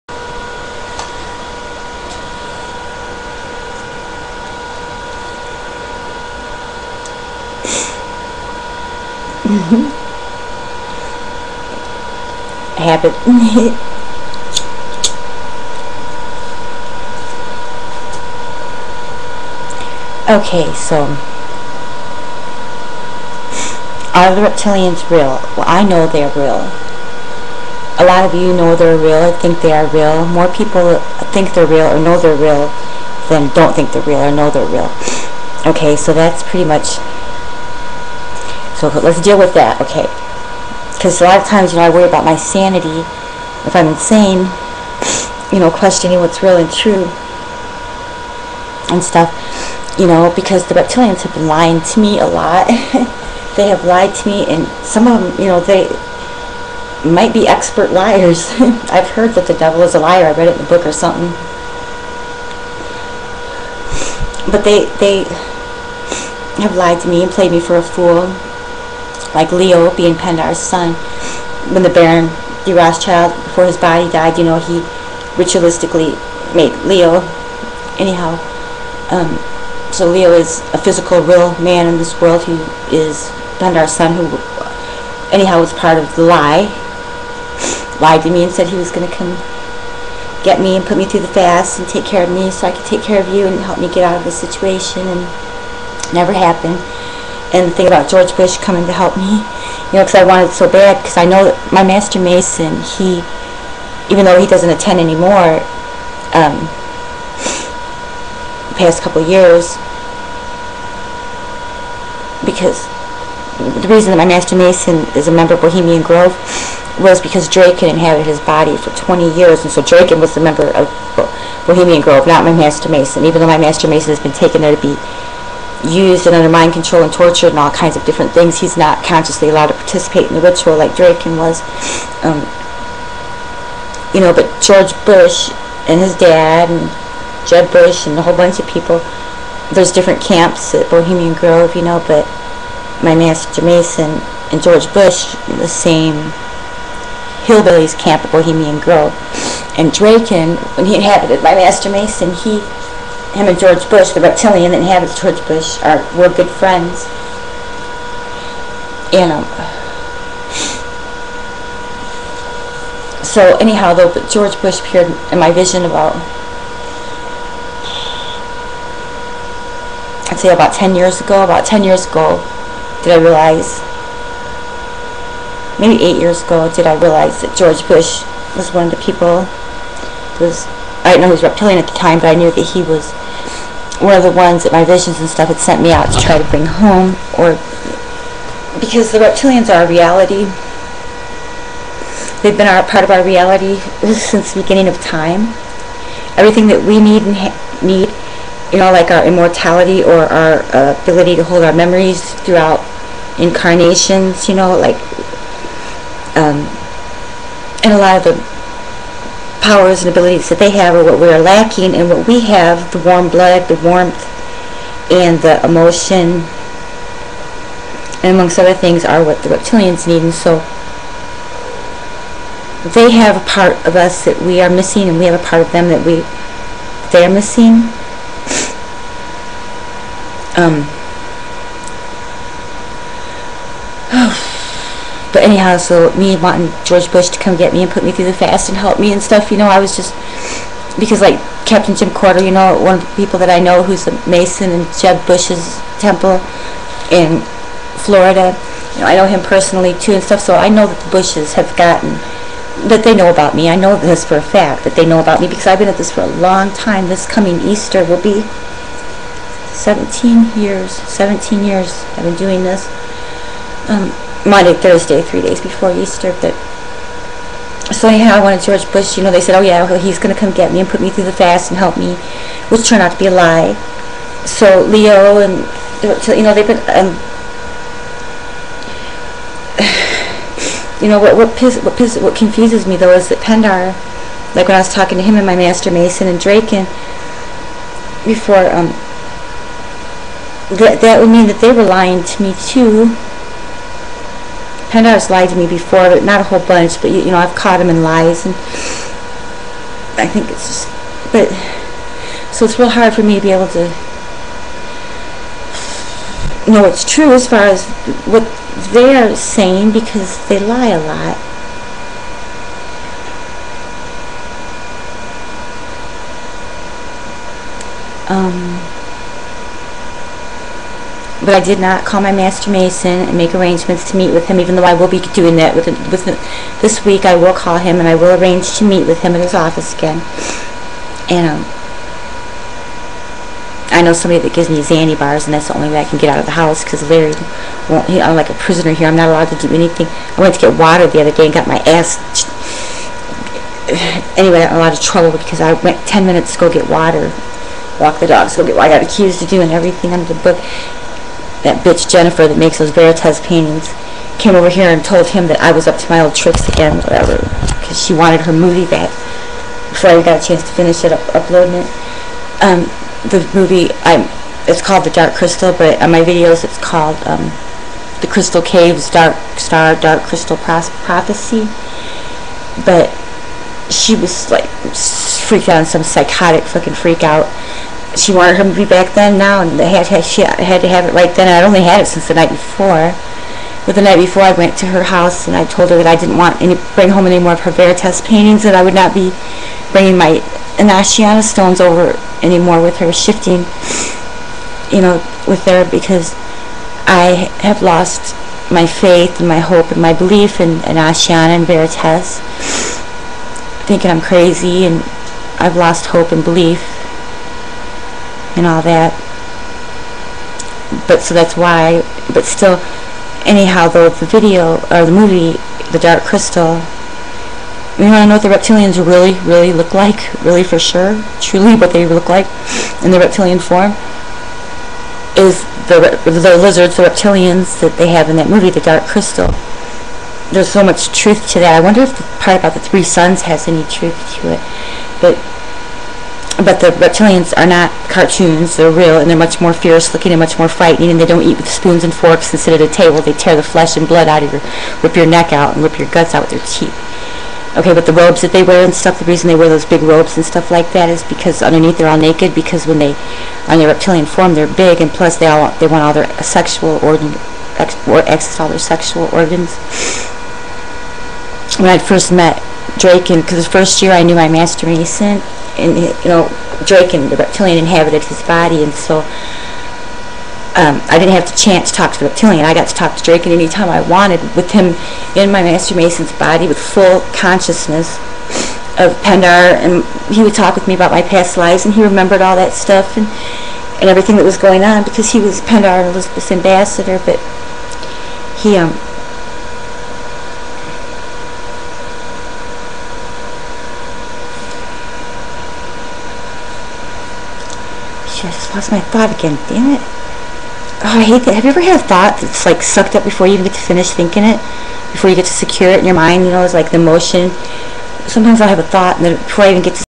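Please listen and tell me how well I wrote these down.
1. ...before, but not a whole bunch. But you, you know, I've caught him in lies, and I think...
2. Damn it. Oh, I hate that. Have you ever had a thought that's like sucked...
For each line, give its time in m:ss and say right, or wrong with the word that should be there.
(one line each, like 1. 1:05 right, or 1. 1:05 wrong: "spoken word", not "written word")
1. 4:55 right
2. 8:19 right.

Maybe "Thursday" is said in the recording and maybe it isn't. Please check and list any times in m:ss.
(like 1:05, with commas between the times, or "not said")
4:24.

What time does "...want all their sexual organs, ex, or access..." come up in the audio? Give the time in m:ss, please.
7:35.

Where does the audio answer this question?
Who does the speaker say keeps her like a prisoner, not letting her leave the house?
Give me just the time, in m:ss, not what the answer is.
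5:37.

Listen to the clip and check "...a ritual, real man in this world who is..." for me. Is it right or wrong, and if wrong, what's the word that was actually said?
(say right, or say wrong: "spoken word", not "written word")
wrong: "physical", not "ritual".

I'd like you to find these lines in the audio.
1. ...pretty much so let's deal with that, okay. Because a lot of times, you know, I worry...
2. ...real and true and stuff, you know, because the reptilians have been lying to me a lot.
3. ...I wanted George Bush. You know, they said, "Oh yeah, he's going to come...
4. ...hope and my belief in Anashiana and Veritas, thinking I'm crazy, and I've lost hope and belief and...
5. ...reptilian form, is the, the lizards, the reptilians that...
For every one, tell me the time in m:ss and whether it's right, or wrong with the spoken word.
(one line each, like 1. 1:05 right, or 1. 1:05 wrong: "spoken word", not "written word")
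1. 0:36 right
2. 0:46 right
3. 4:28 right
4. 6:39 right
5. 7:03 right.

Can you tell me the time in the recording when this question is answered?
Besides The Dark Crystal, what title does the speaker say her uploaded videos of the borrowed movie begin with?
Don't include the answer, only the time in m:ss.
6:08.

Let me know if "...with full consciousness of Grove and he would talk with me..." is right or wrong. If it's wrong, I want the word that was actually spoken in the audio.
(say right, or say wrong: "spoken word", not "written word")
wrong: "Pindar", not "Grove".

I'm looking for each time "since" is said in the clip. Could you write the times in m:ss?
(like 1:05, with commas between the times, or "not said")
3:14, 6:22.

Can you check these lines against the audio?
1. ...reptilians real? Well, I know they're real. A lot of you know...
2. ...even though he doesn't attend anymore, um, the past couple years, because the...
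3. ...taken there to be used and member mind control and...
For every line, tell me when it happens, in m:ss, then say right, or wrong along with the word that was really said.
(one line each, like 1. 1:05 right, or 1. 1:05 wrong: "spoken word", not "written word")
1. 0:24 right
2. 1:44 right
3. 2:04 wrong: "under", not "member".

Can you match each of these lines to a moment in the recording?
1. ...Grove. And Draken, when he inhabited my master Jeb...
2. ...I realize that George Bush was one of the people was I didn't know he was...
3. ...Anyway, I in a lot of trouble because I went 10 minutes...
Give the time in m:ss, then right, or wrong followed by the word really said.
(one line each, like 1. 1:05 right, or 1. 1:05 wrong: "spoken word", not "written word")
1. 2:28 wrong: "Mason", not "Jeb"
2. 2:56 right
3. 5:44 right.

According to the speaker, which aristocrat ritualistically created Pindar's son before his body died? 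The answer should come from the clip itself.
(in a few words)
Baron de Rothschild.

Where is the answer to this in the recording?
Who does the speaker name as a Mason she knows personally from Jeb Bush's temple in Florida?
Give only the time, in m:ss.
4:01.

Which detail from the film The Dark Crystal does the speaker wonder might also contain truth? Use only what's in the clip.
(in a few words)
The three suns.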